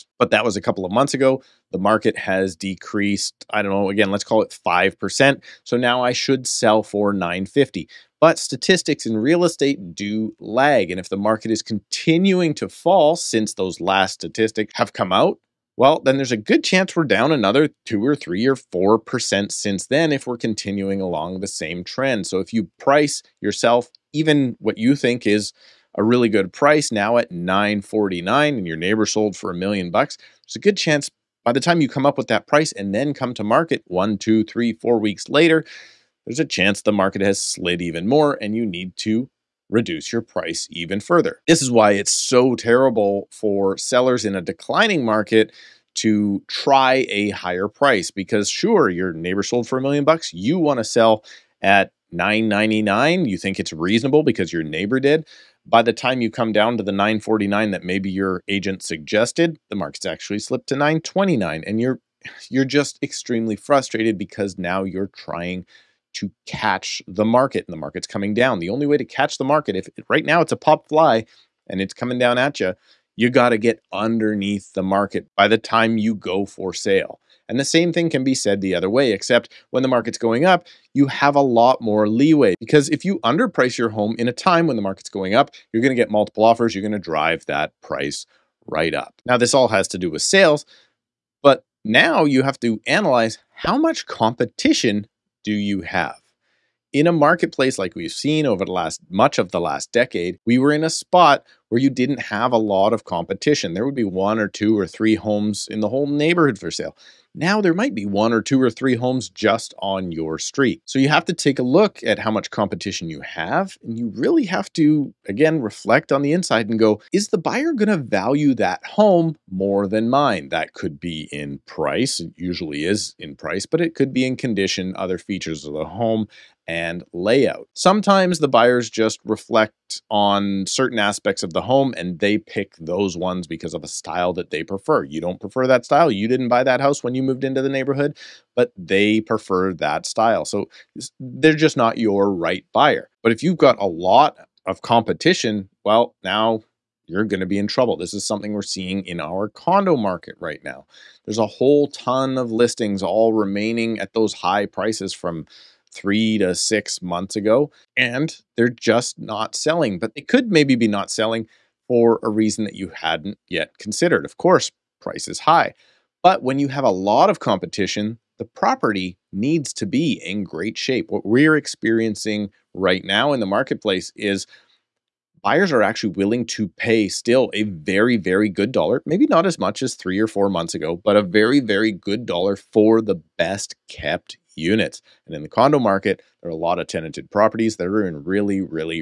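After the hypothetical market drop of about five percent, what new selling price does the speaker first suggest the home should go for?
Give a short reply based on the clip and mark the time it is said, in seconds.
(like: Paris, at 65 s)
950, at 7 s.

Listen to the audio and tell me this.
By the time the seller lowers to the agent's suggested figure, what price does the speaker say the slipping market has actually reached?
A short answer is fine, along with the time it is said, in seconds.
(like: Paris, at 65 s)
929, at 60 s.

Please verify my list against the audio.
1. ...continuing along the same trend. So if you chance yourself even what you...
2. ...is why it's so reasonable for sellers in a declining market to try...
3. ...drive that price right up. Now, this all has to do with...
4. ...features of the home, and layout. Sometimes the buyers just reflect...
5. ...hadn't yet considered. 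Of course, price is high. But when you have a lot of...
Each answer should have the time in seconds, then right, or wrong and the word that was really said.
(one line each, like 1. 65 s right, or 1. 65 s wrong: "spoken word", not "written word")
1. 20 s wrong: "price", not "chance"
2. 41 s wrong: "terrible", not "reasonable"
3. 86 s right
4. 125 s right
5. 162 s right.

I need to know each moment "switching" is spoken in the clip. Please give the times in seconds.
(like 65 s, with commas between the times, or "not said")
not said.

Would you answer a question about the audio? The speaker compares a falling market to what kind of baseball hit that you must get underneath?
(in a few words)
pop fly.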